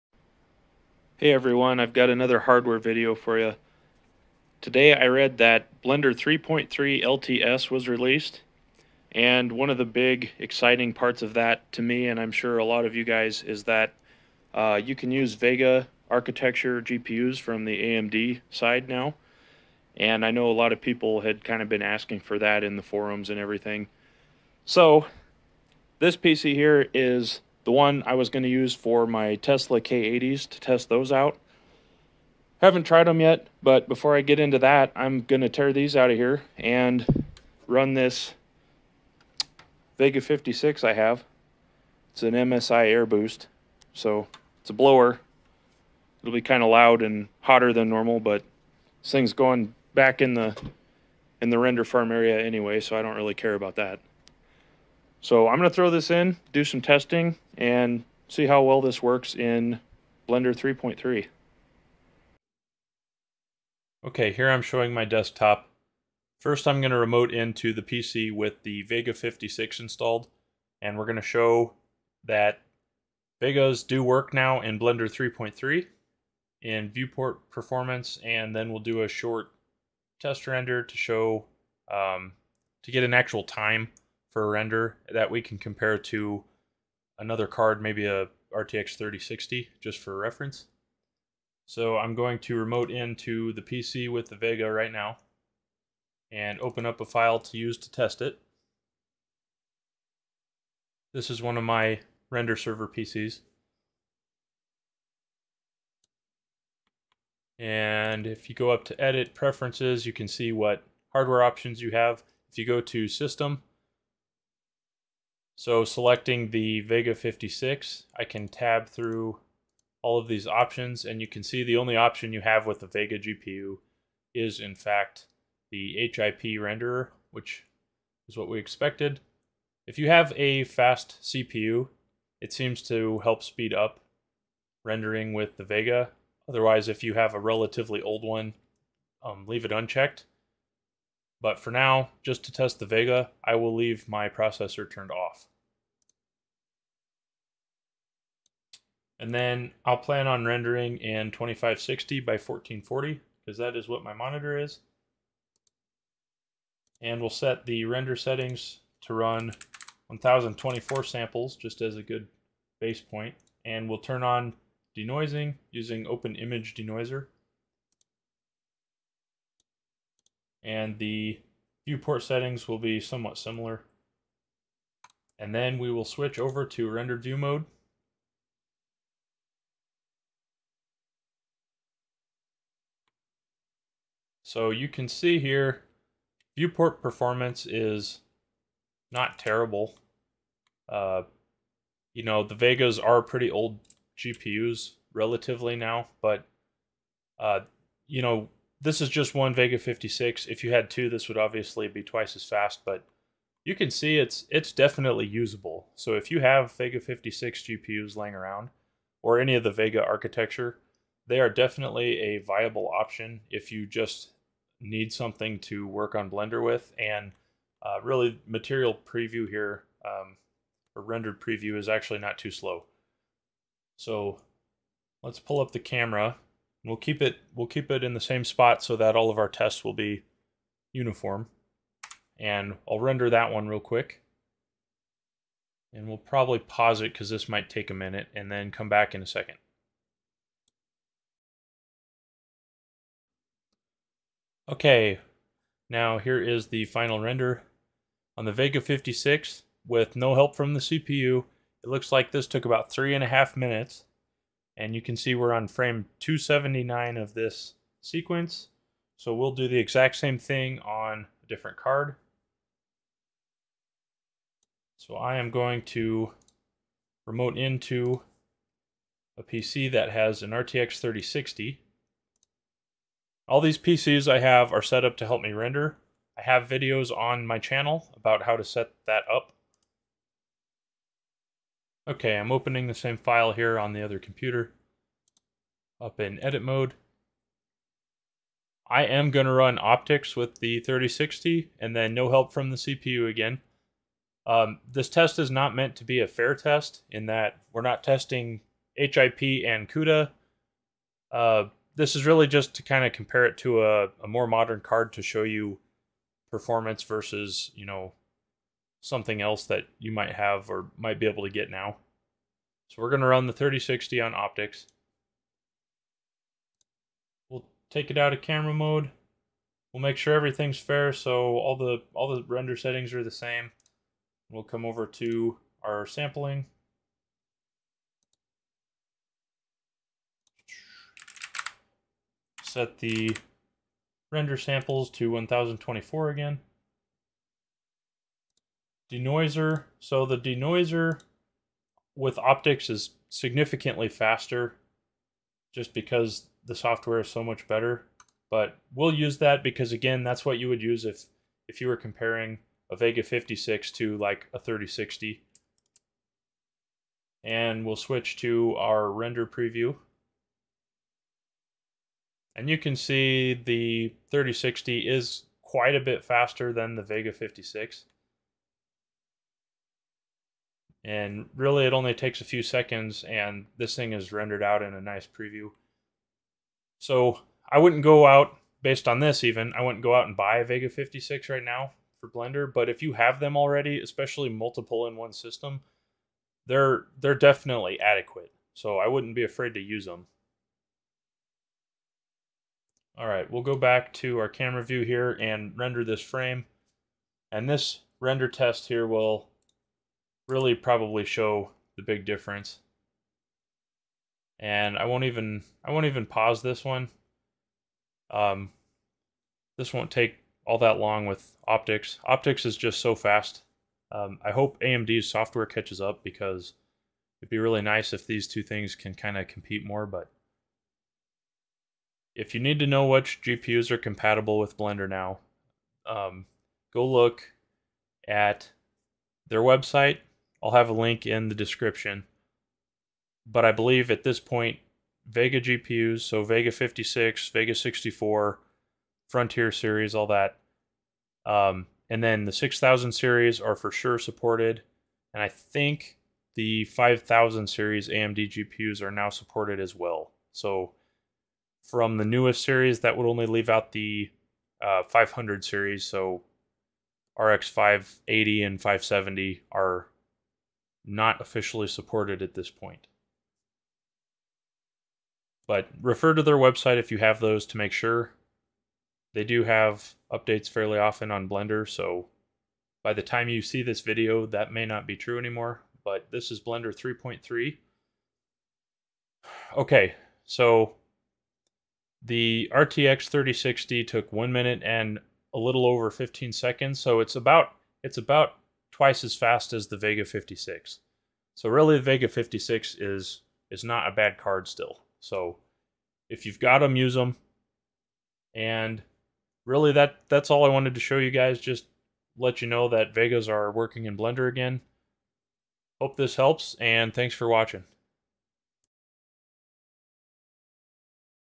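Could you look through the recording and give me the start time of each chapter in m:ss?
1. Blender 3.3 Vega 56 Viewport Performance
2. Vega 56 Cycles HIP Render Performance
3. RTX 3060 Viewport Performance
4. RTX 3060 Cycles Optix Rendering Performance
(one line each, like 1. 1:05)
1. 1:01
2. 3:50
3. 4:28
4. 6:40.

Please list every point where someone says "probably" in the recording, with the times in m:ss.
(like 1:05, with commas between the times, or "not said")
3:56, 6:40.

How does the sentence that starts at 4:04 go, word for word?
Okay, now here is the final render.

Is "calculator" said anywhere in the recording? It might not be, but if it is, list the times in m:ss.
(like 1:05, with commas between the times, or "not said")
not said.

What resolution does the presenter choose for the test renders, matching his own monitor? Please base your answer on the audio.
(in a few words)
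2560 by 1440.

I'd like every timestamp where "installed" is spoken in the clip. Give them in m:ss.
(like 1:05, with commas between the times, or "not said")
1:09.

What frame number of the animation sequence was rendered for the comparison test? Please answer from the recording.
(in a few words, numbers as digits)
279.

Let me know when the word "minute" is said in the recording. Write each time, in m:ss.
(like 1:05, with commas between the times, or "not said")
3:57, 4:13, 8:04.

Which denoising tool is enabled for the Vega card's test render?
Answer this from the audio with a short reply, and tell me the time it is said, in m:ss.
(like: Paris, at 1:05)
Open Image Denoiser, at 2:46.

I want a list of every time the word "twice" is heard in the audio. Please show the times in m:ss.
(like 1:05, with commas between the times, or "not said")
3:22, 8:08.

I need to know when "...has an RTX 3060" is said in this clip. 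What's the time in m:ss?
4:30.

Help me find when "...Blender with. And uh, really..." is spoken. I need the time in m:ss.
3:36.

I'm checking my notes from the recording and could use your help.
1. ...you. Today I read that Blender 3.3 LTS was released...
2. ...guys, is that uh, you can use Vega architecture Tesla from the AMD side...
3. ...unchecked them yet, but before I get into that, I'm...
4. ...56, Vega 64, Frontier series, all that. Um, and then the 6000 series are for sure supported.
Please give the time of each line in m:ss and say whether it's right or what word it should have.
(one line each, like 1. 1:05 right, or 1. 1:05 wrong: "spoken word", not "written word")
1. 0:03 right
2. 0:13 wrong: "GPUs", not "Tesla"
3. 0:32 wrong: "tried", not "unchecked"
4. 7:16 right.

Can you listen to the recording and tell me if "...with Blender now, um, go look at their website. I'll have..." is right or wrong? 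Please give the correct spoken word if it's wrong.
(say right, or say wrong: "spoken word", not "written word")
right.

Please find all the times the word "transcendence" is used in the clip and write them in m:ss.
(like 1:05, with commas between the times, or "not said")
not said.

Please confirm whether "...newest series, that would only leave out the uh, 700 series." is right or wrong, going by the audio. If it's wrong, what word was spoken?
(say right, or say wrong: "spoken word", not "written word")
wrong: "500", not "700".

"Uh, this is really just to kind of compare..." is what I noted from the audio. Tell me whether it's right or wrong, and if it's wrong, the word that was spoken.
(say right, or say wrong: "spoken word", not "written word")
right.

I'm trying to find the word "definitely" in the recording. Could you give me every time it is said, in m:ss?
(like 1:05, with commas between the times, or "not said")
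3:24, 3:31, 6:27.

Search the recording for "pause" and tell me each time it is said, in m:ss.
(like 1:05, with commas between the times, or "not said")
3:56, 6:46.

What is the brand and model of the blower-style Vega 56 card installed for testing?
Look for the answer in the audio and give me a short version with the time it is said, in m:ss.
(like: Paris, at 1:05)
MSI Air Boost, at 0:42.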